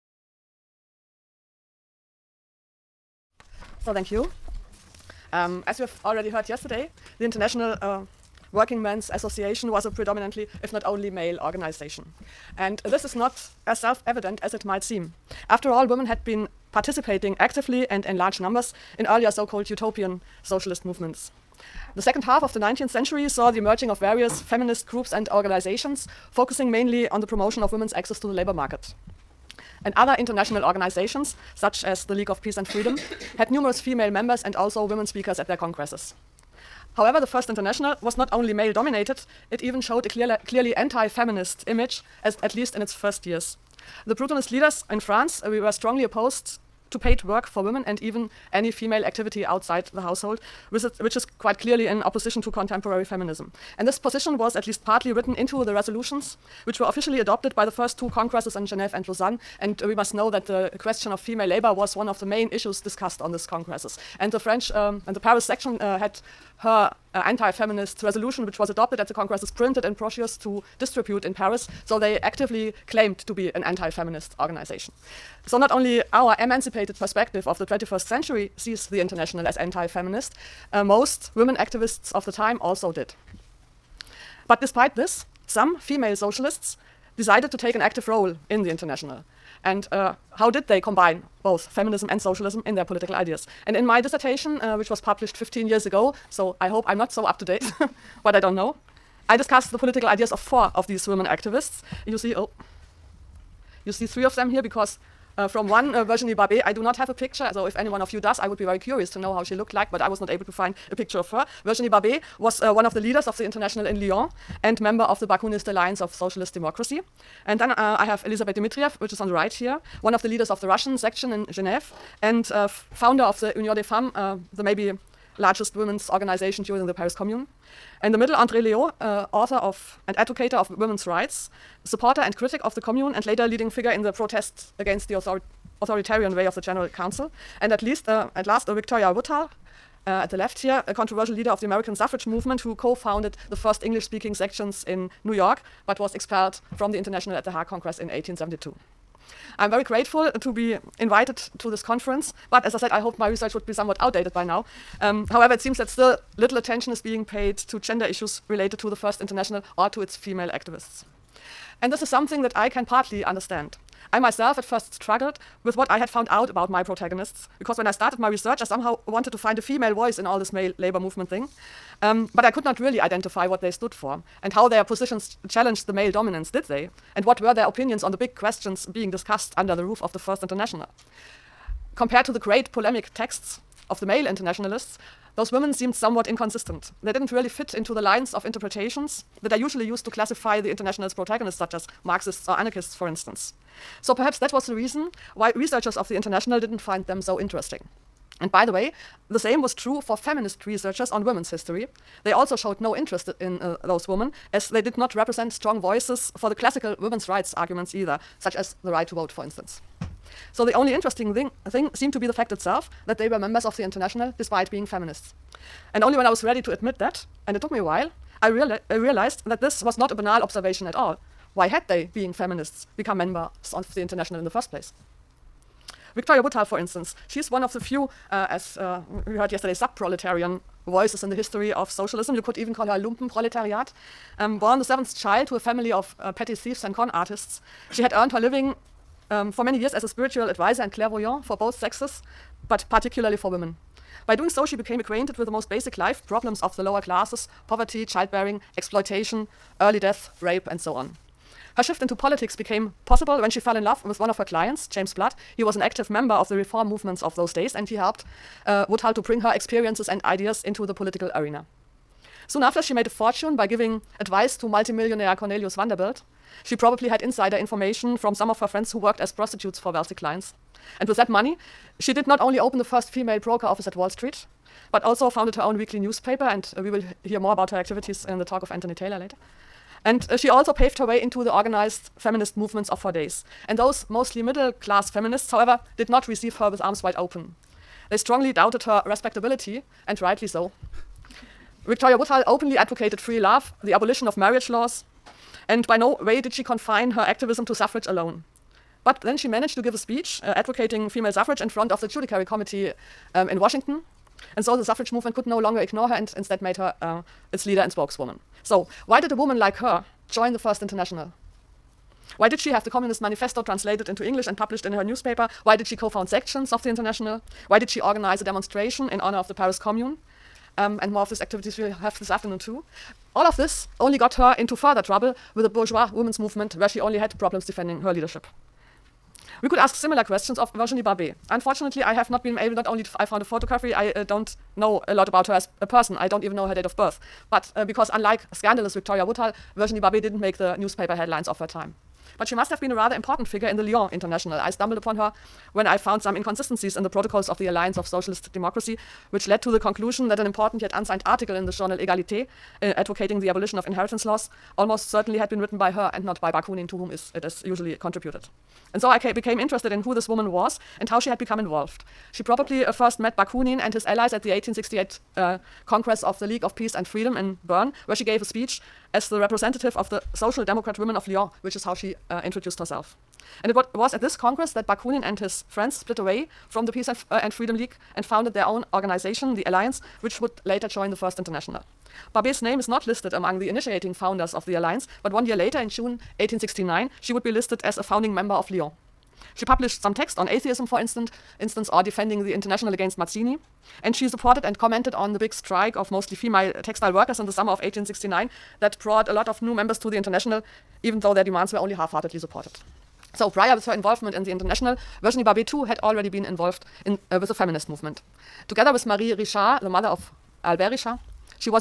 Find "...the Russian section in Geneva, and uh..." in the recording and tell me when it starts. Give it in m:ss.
2:00.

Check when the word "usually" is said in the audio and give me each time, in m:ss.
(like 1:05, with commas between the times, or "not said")
3:09, 5:57.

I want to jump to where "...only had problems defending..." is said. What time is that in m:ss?
5:26.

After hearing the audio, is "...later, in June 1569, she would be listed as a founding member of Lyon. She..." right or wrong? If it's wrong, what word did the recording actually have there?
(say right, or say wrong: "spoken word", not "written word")
wrong: "1869", not "1569".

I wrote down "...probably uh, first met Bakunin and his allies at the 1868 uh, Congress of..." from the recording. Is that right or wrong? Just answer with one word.
right.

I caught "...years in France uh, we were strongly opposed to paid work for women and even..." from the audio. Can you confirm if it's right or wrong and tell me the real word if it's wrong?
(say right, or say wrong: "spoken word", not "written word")
wrong: "leaders", not "years".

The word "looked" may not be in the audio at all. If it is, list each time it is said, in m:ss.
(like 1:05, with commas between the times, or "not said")
1:49.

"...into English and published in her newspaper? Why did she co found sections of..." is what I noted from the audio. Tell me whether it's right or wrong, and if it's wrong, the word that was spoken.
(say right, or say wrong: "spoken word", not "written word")
right.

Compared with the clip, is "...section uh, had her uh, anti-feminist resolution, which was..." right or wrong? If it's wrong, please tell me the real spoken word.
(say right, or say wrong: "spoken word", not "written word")
right.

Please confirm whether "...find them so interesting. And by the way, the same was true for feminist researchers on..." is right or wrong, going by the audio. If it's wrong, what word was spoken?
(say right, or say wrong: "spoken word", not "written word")
right.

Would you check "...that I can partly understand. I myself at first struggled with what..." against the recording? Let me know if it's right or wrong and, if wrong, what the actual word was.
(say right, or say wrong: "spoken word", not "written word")
right.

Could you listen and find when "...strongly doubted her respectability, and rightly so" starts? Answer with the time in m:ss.
4:48.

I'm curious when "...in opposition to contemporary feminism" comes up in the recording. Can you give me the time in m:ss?
0:51.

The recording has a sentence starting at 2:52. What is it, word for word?
Um, but I could not really identify what they stood for and how their positions challenged the male dominance, did they?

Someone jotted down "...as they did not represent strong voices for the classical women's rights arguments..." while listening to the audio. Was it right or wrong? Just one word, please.
right.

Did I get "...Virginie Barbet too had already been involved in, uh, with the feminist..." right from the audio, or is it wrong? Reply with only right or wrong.
right.